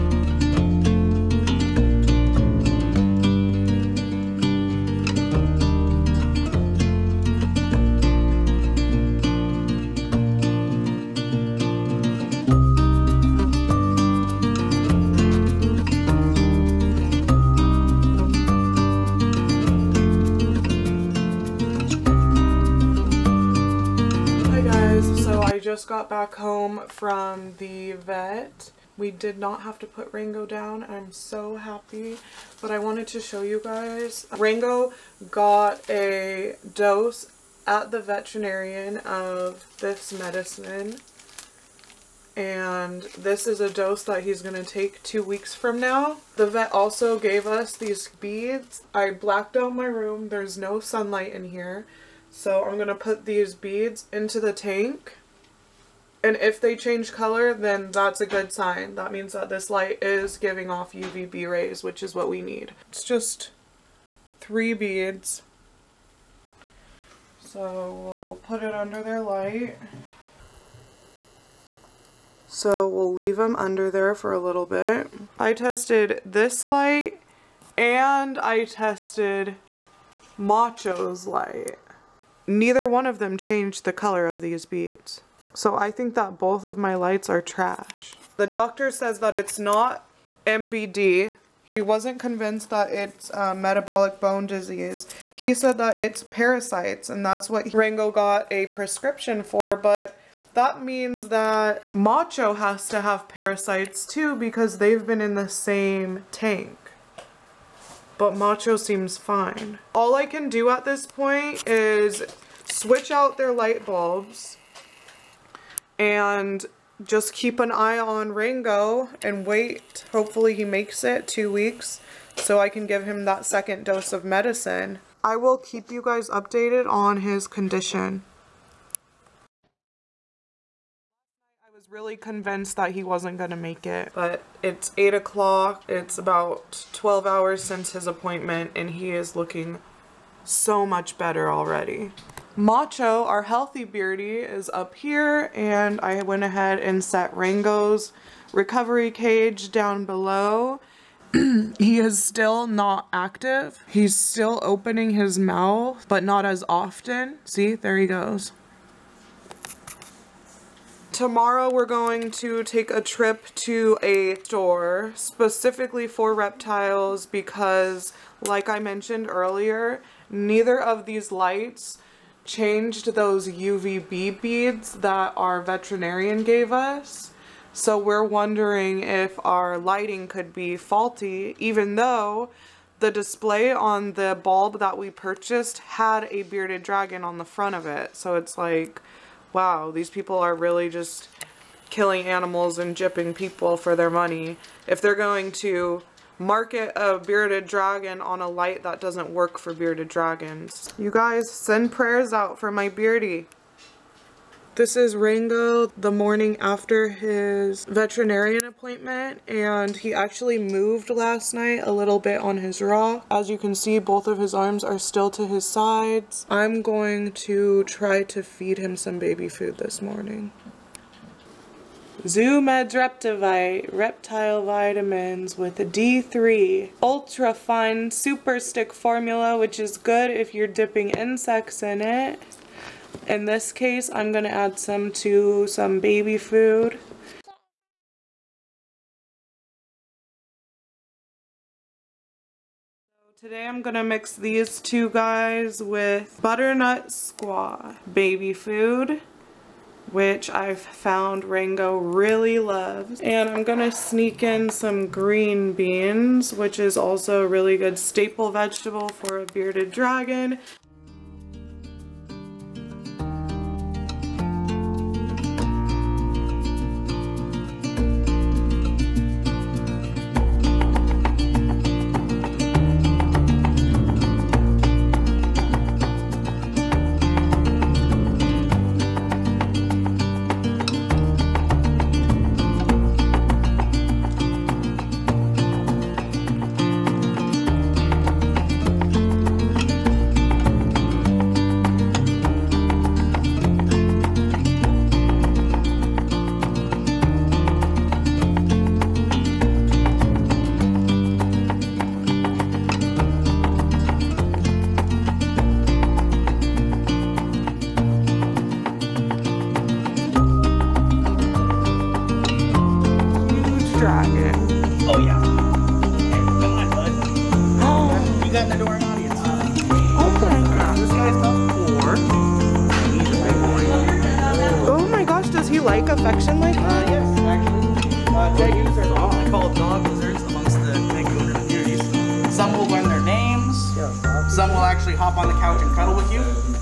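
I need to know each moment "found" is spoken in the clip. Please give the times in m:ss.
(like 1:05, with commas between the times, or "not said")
4:10.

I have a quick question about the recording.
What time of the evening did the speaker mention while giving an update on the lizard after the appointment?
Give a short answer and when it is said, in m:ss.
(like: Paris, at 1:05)
8 o'clock, at 2:14.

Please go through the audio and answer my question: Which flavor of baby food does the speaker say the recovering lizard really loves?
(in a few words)
butternut squash.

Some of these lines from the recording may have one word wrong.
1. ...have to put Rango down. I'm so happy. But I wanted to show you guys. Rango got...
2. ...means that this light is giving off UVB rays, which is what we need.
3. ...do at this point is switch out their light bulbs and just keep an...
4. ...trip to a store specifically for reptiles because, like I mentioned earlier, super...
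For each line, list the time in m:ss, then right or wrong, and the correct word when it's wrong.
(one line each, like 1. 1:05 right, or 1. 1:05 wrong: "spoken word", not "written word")
1. 0:29 right
2. 0:59 right
3. 1:50 right
4. 2:42 wrong: "neither", not "super".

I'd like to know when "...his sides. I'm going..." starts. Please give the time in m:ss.
3:35.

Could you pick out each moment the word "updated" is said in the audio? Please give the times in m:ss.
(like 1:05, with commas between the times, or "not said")
2:06.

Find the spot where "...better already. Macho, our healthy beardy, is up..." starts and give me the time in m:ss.
2:21.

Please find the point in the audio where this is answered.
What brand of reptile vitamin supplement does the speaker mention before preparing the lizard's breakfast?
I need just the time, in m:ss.
3:42.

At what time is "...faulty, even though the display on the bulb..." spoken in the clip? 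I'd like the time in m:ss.
3:00.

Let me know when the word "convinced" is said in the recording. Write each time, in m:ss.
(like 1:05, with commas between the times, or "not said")
1:32, 2:12.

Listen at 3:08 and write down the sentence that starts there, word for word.
So it's like, wow, these people are really just killing animals and jipping people for their money.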